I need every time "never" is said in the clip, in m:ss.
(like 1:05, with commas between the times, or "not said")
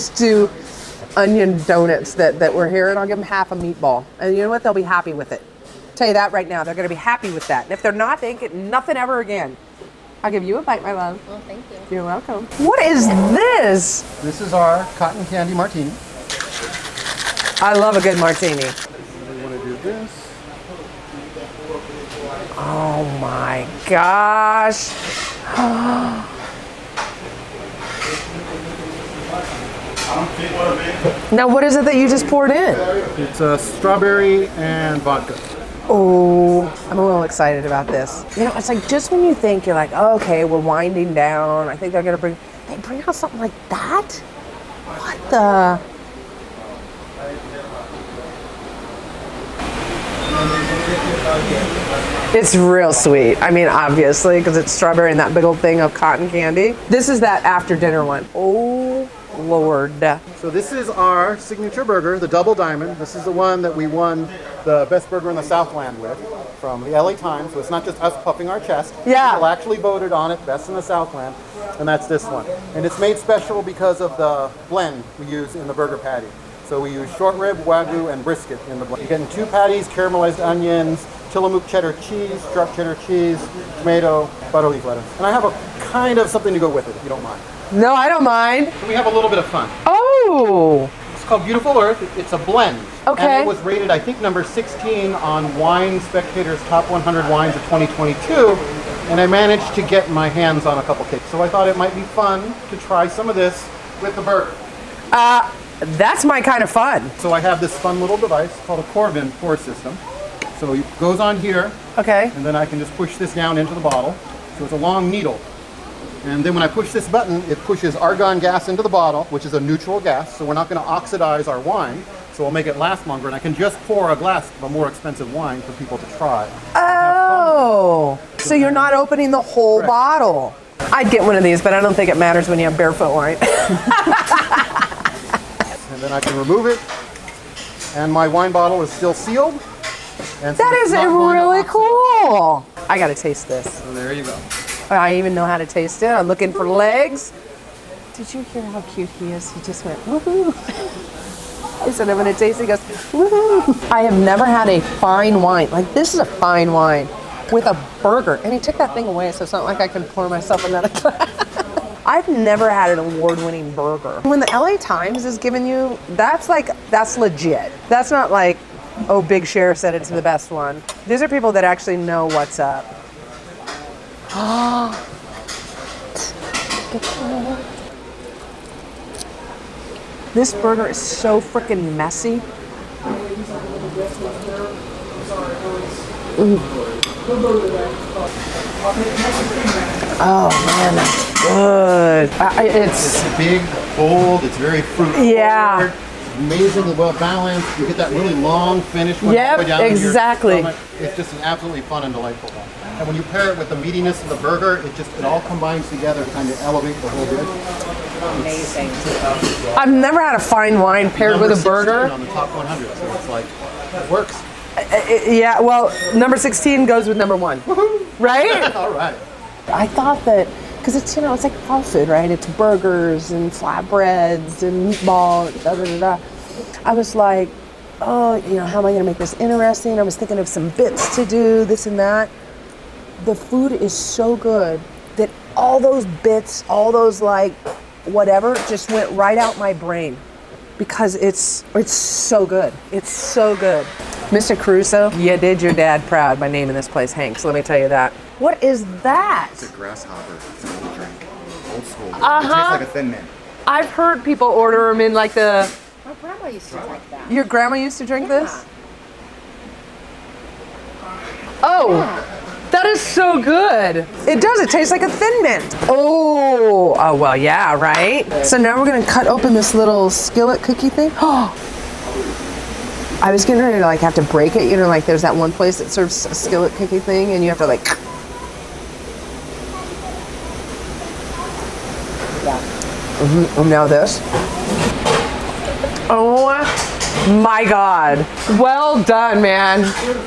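2:34, 2:42, 3:29.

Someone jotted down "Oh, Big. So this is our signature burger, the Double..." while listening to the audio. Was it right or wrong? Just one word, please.
wrong.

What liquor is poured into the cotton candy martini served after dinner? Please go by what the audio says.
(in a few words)
Strawberry and vodka.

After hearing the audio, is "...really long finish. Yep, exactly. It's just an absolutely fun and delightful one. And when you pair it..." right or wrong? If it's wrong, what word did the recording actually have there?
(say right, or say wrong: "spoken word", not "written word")
right.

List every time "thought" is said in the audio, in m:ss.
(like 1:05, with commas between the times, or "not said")
1:41, 3:39.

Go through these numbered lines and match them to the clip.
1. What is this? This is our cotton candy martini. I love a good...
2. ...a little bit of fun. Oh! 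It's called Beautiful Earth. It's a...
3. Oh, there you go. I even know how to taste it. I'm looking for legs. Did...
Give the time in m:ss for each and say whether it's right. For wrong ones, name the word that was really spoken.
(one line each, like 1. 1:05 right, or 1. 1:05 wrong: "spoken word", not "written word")
1. 0:12 right
2. 1:29 right
3. 2:23 right.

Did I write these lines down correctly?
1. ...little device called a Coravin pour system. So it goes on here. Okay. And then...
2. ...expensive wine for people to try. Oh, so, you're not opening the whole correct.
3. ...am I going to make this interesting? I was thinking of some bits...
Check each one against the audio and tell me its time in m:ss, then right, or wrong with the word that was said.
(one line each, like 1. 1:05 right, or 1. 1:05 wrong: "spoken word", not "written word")
1. 1:47 right
2. 2:04 right
3. 3:48 right.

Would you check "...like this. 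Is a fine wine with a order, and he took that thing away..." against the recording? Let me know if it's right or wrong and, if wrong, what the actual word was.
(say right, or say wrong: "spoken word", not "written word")
wrong: "burger", not "order".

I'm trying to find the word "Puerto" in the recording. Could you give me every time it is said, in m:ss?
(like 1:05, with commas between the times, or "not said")
not said.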